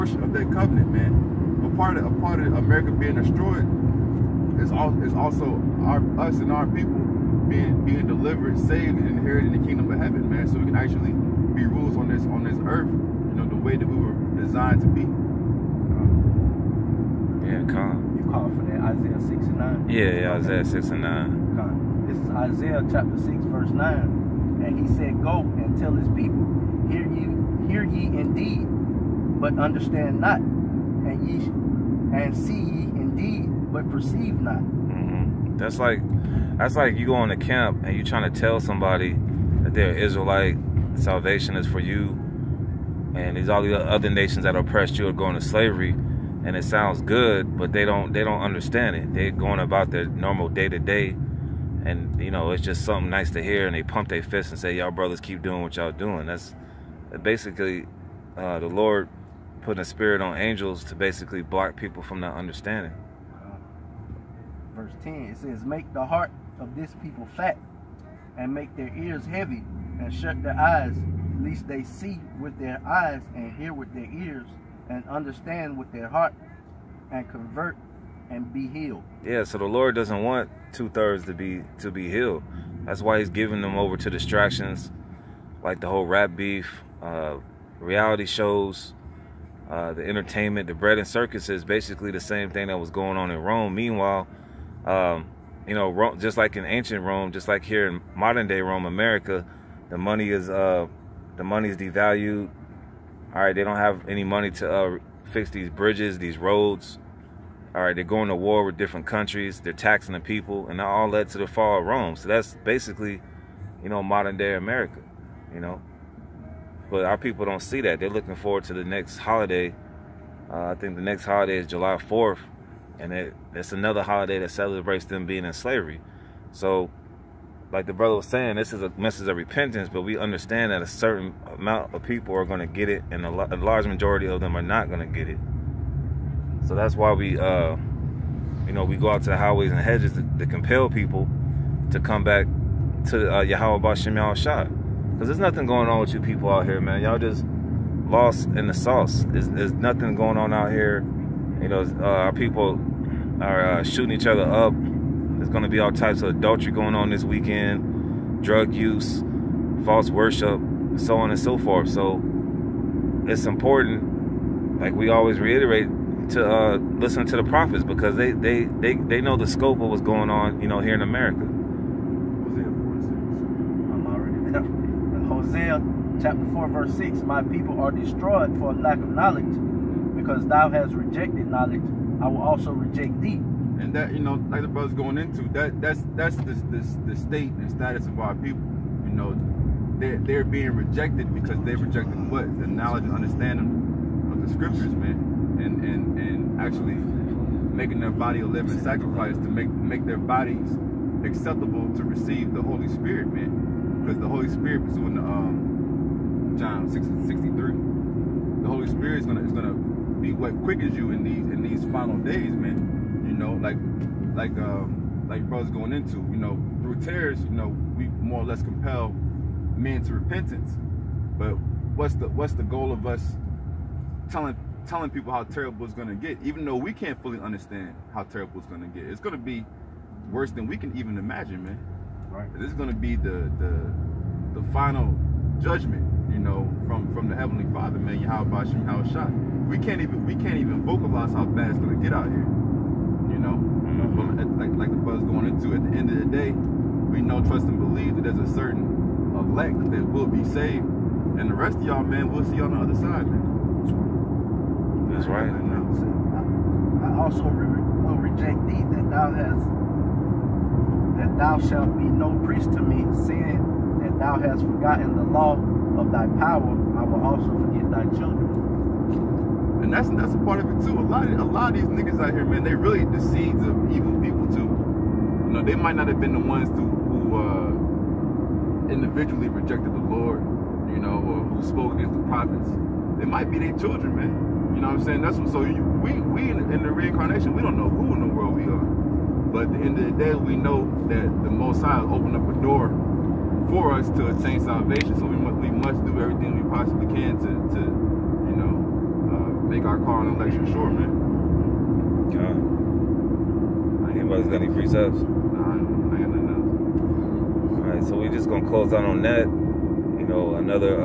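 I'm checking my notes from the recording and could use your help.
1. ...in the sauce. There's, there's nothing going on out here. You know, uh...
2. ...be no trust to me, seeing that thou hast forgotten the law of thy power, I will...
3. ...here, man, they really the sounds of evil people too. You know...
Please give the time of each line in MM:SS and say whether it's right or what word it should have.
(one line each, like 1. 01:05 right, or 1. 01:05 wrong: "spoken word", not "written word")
1. 02:28 right
2. 04:21 wrong: "priest", not "trust"
3. 04:32 wrong: "seeds", not "sounds".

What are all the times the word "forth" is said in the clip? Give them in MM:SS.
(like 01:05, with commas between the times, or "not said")
02:41.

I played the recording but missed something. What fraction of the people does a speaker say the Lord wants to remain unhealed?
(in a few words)
two-thirds.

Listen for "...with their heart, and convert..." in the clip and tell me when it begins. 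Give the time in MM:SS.
01:15.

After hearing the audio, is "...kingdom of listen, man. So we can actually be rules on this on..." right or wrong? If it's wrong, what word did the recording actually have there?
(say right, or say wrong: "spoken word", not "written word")
wrong: "heaven", not "listen".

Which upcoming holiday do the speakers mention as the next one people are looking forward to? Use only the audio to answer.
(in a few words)
July 4th.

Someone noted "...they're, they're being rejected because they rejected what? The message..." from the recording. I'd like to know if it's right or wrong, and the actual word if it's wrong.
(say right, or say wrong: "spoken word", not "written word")
wrong: "knowledge", not "message".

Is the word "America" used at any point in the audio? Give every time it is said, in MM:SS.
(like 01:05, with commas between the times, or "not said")
00:02, 01:38, 01:54, 02:51.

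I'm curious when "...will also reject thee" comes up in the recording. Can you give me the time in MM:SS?
03:02.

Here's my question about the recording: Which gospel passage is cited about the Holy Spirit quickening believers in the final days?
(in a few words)
John 6:63.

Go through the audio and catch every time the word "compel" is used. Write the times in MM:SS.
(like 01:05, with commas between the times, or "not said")
02:20, 03:38.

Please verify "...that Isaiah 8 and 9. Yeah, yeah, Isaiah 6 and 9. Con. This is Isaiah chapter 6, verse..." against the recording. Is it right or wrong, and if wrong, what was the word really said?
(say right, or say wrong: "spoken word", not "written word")
wrong: "6", not "8".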